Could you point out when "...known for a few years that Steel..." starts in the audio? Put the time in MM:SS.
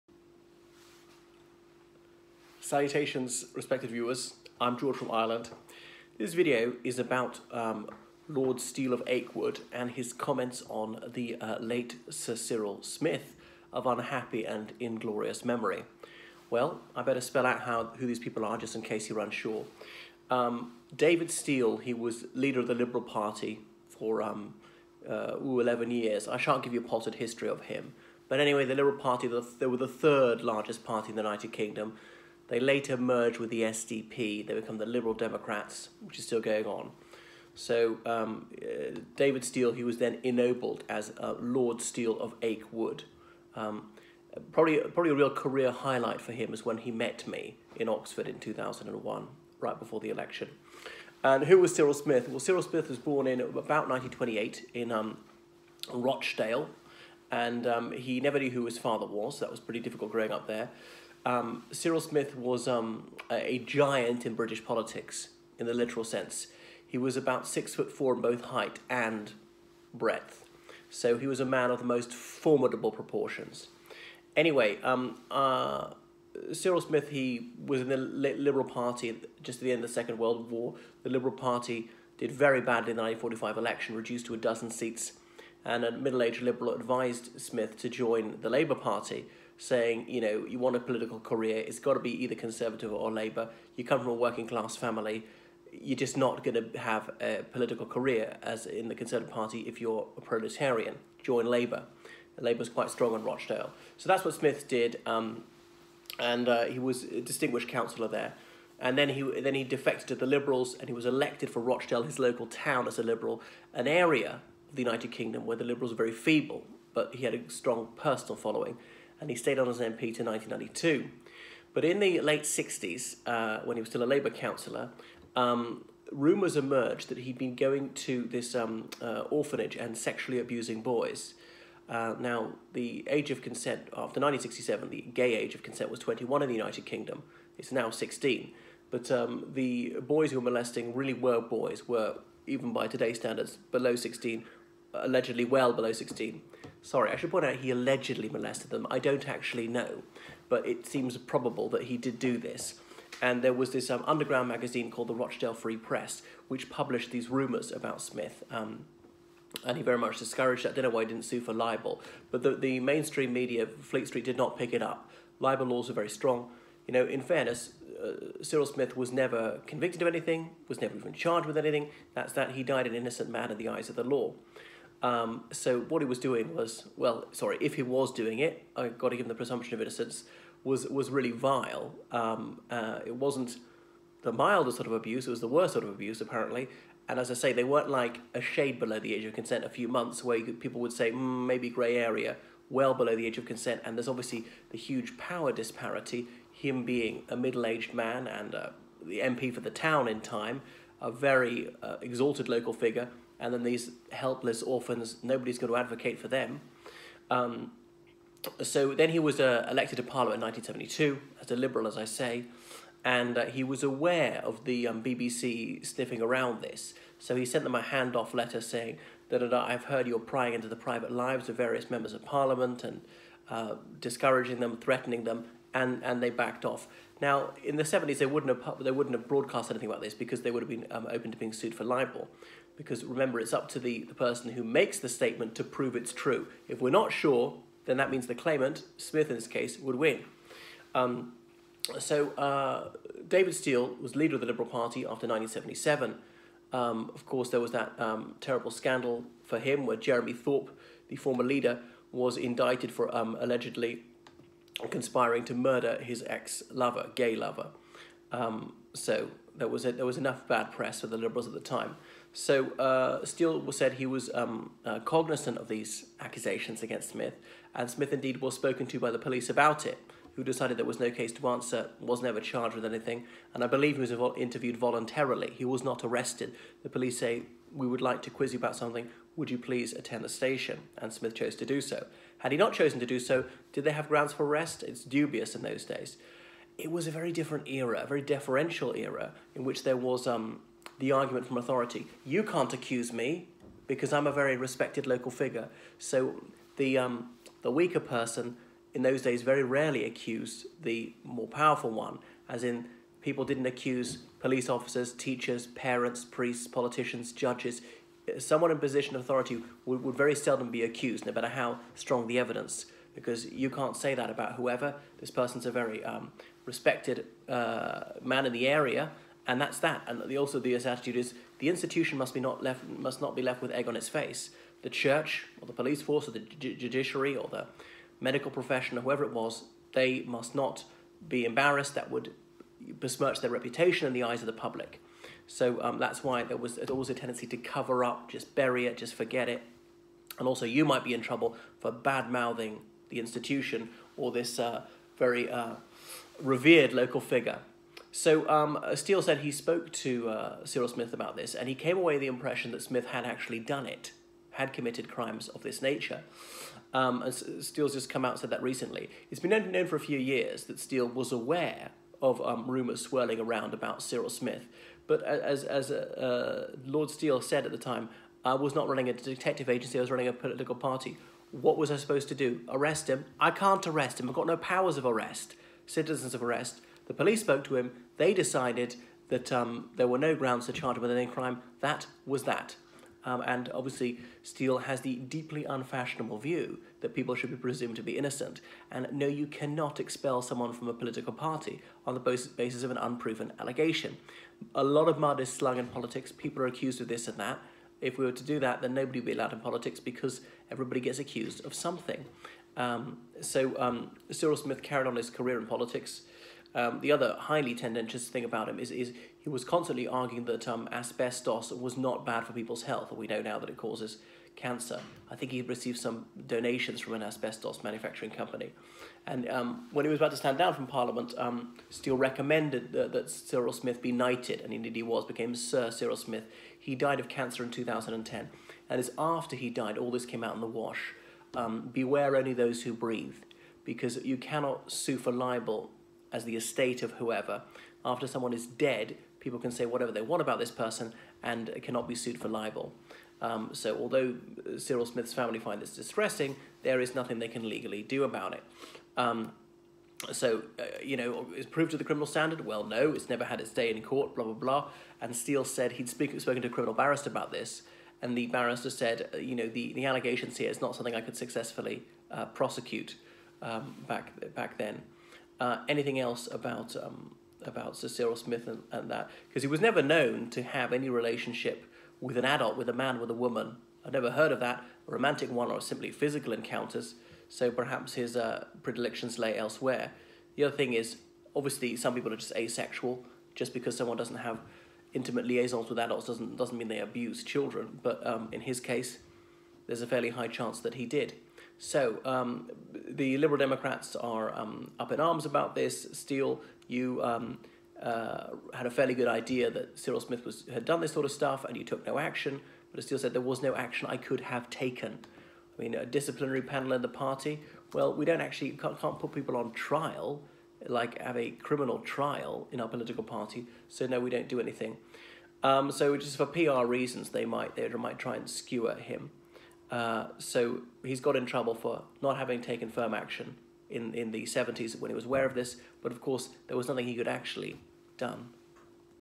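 05:59.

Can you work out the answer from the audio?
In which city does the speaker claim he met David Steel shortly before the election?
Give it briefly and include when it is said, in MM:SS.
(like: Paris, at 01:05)
Oxford, at 00:47.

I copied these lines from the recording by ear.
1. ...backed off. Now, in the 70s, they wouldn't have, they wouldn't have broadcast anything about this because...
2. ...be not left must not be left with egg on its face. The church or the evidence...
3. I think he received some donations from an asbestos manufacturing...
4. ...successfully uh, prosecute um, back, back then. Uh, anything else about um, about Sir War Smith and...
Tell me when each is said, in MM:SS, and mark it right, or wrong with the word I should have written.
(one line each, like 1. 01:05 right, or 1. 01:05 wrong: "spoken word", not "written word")
1. 03:46 right
2. 05:22 wrong: "police", not "evidence"
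3. 06:55 right
4. 07:41 wrong: "Cyril", not "War".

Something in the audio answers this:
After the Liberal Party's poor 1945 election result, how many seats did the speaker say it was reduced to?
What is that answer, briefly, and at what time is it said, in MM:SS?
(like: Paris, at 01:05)
a dozen, at 01:24.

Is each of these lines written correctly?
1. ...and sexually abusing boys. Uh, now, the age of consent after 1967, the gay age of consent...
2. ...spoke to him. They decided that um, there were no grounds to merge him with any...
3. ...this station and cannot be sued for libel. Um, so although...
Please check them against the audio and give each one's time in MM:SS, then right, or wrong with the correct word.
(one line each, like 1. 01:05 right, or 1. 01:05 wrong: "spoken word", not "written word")
1. 02:09 right
2. 06:17 wrong: "charge", not "merge"
3. 07:20 wrong: "person", not "station".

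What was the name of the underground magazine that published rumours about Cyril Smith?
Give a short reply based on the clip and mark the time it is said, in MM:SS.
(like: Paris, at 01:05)
Rochdale Free Press, at 02:35.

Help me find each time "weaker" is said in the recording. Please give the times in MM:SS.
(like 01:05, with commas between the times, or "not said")
04:57.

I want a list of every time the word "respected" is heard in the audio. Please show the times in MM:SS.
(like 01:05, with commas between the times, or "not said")
00:03, 04:54, 05:16.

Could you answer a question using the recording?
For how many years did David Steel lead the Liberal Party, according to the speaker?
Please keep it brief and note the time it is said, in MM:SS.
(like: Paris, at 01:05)
11, at 00:25.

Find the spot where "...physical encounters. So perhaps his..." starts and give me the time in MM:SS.
07:56.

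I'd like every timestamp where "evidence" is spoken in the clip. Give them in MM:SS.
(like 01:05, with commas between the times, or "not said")
05:12.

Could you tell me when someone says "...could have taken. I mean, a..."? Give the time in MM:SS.
08:24.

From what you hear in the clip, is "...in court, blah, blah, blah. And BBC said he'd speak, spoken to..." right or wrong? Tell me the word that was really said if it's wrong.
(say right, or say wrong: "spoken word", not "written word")
wrong: "Steel", not "BBC".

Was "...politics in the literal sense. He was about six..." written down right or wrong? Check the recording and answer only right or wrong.
right.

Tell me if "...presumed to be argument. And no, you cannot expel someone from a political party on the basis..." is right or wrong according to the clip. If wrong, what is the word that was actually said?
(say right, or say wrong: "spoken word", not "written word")
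wrong: "innocent", not "argument".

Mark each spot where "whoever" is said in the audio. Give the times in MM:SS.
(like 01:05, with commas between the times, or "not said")
05:14, 05:29, 07:17.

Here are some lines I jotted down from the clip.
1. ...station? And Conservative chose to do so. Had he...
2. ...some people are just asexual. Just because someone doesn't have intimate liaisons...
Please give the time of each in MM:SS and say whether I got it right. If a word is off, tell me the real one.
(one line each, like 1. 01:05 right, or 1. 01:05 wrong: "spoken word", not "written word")
1. 04:40 wrong: "Smith", not "Conservative"
2. 08:01 right.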